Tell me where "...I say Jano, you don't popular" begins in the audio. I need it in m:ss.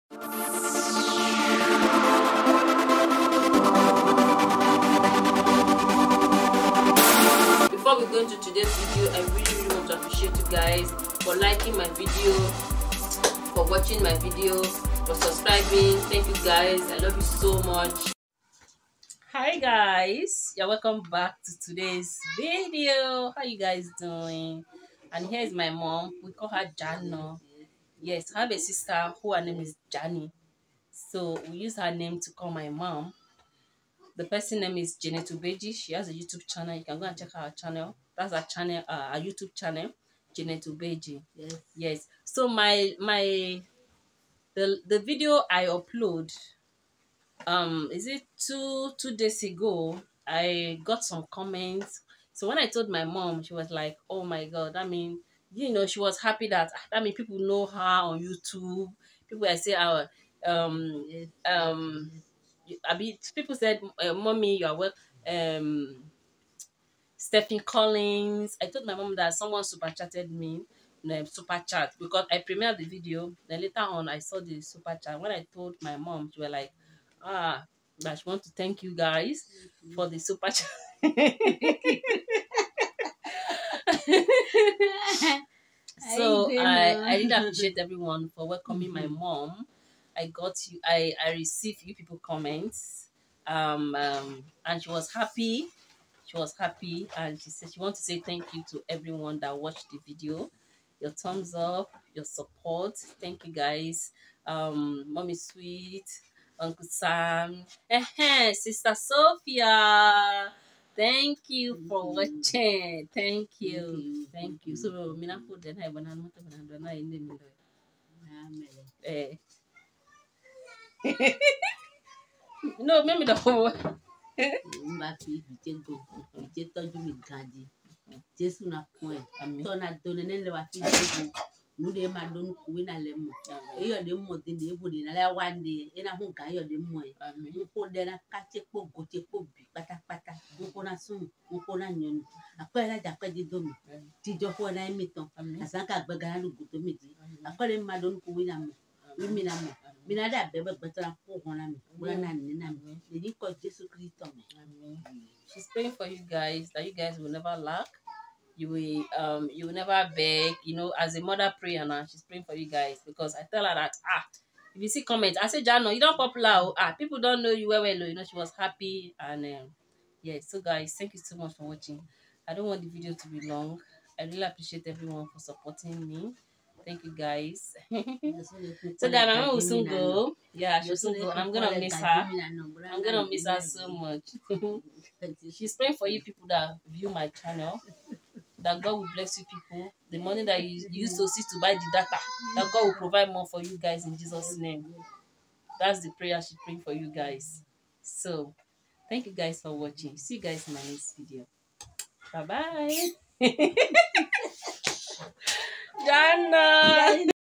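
2:45.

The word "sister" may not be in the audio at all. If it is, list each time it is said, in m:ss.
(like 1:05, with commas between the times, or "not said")
0:28, 1:48.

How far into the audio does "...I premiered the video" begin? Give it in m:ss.
1:12.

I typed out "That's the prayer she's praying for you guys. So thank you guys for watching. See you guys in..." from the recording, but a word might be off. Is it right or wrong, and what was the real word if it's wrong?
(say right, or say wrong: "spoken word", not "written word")
right.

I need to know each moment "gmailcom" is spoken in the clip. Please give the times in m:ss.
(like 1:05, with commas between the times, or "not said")
not said.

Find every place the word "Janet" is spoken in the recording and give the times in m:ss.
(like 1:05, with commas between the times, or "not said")
0:34, 0:40.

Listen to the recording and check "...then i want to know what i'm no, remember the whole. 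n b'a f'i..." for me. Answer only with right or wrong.
right.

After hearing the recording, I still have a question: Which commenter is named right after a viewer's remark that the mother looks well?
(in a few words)
Stephanie Collins.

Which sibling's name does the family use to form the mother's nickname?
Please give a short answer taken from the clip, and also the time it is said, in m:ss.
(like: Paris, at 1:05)
Jani, at 0:29.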